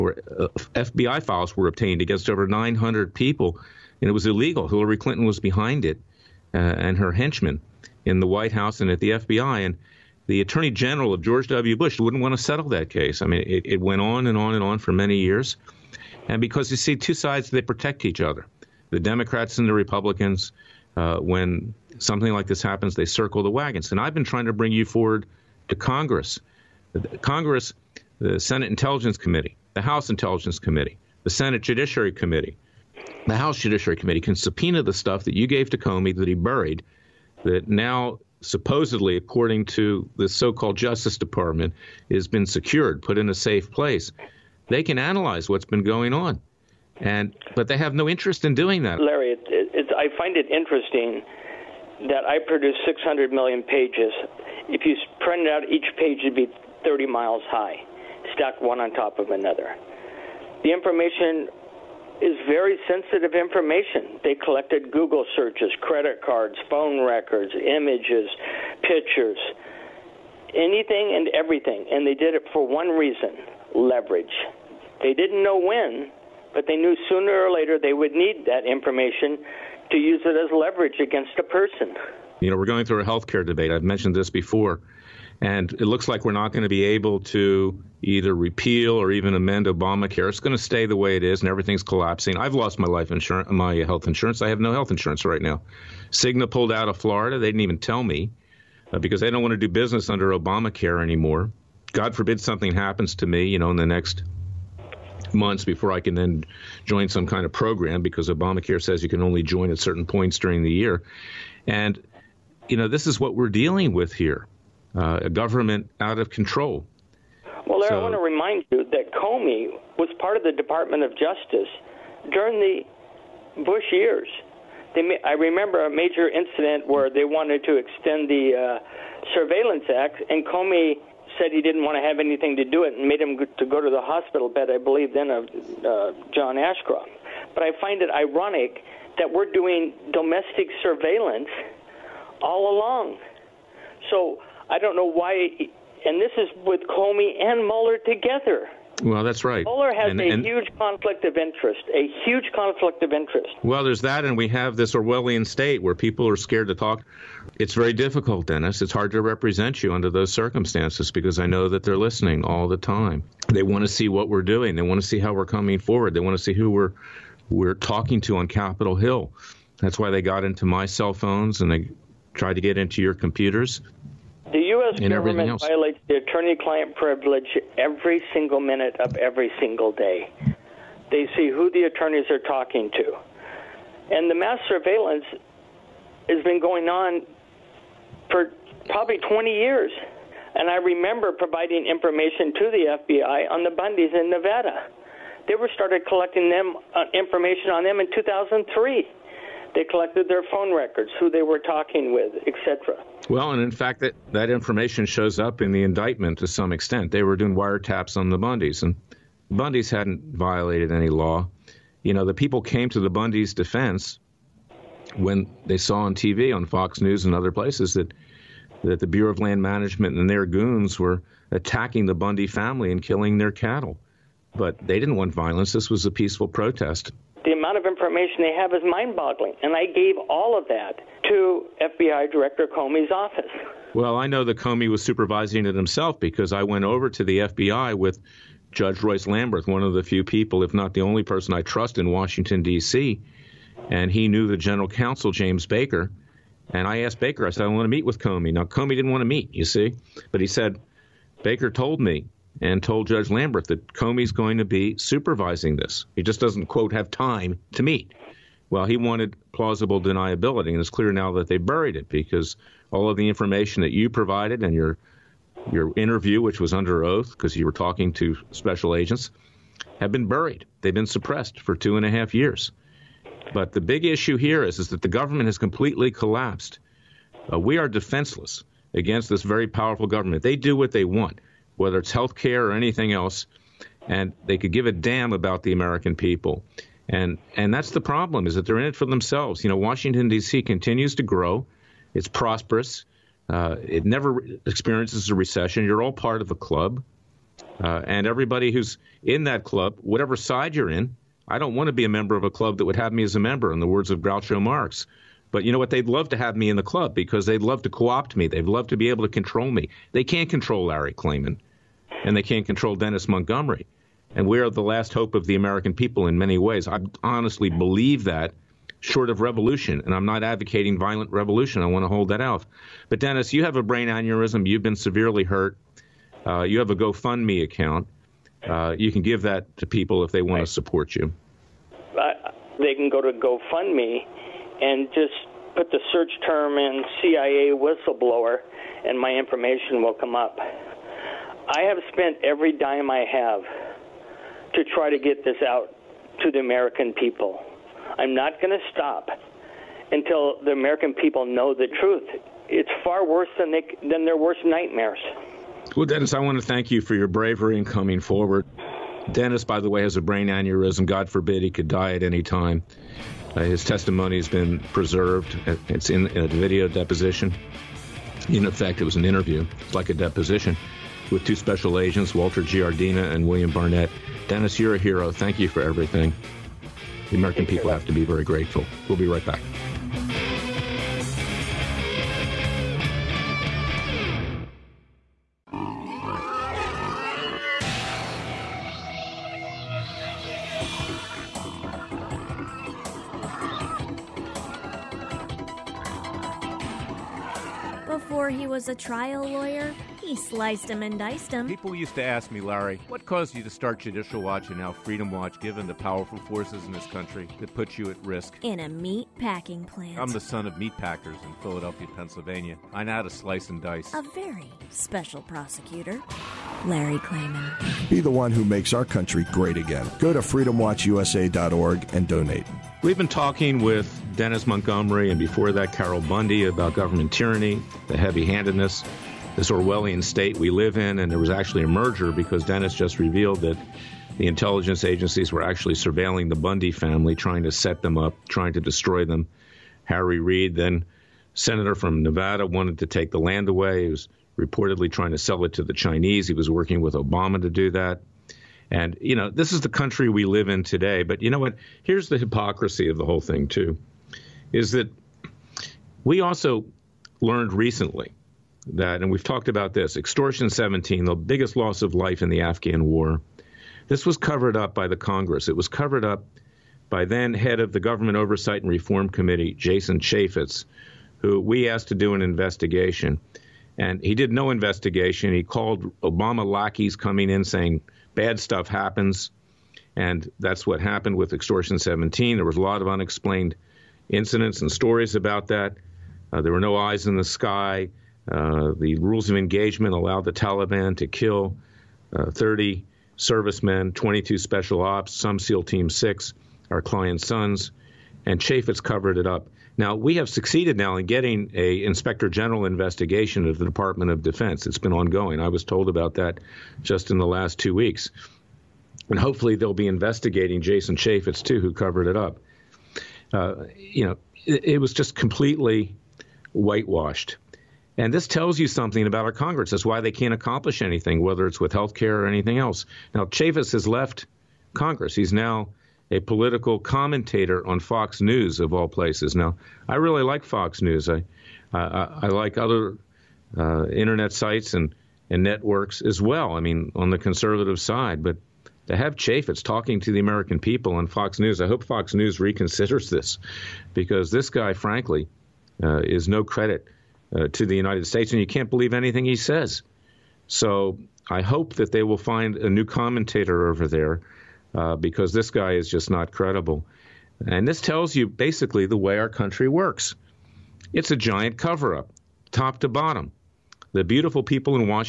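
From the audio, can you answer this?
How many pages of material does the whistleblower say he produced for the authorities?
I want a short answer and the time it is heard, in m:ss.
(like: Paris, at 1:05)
600 million, at 0:52.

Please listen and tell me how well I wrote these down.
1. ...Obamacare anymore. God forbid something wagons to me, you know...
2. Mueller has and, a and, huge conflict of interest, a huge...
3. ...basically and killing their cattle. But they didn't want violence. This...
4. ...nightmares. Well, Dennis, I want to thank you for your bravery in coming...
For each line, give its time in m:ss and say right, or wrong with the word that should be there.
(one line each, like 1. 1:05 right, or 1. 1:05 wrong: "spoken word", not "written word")
1. 1:40 wrong: "happens", not "wagons"
2. 2:29 right
3. 3:42 wrong: "family", not "basically"
4. 5:54 right.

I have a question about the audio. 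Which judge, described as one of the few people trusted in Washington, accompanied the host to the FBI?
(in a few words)
Royce Lamberth.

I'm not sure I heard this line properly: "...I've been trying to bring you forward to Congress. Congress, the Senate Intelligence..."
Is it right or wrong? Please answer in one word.
right.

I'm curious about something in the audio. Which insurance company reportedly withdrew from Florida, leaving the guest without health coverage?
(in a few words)
Cigna.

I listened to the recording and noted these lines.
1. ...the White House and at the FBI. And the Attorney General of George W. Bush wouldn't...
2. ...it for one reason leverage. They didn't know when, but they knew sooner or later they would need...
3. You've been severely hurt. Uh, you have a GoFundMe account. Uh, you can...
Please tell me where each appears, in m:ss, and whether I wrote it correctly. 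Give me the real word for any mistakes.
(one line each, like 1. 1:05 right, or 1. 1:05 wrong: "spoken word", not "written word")
1. 0:08 right
2. 1:12 right
3. 5:24 right.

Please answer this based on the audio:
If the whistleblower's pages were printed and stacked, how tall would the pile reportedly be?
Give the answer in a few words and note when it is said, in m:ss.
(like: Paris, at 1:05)
30 miles, at 0:56.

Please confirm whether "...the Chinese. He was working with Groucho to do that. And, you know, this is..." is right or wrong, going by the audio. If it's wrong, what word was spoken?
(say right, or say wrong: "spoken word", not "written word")
wrong: "Obama", not "Groucho".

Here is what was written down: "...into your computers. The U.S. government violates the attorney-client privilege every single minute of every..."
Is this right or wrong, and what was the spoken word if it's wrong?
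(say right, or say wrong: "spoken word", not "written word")
right.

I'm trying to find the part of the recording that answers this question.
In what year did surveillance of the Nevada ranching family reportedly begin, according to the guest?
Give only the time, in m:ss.
3:18.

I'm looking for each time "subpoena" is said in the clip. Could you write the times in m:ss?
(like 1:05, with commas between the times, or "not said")
0:34.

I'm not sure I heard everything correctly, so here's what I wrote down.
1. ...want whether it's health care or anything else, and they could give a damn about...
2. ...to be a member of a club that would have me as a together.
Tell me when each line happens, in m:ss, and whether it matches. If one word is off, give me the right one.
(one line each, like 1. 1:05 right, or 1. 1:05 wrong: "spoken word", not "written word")
1. 4:41 right
2. 5:01 wrong: "member", not "together".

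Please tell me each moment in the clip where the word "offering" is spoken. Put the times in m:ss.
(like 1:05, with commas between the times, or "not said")
not said.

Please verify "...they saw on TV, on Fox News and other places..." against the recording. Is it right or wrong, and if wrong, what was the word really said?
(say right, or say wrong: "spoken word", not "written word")
right.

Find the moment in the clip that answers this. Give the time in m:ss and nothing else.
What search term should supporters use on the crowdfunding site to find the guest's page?
5:37.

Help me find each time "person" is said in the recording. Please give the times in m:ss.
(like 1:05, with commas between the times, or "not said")
1:21, 4:01.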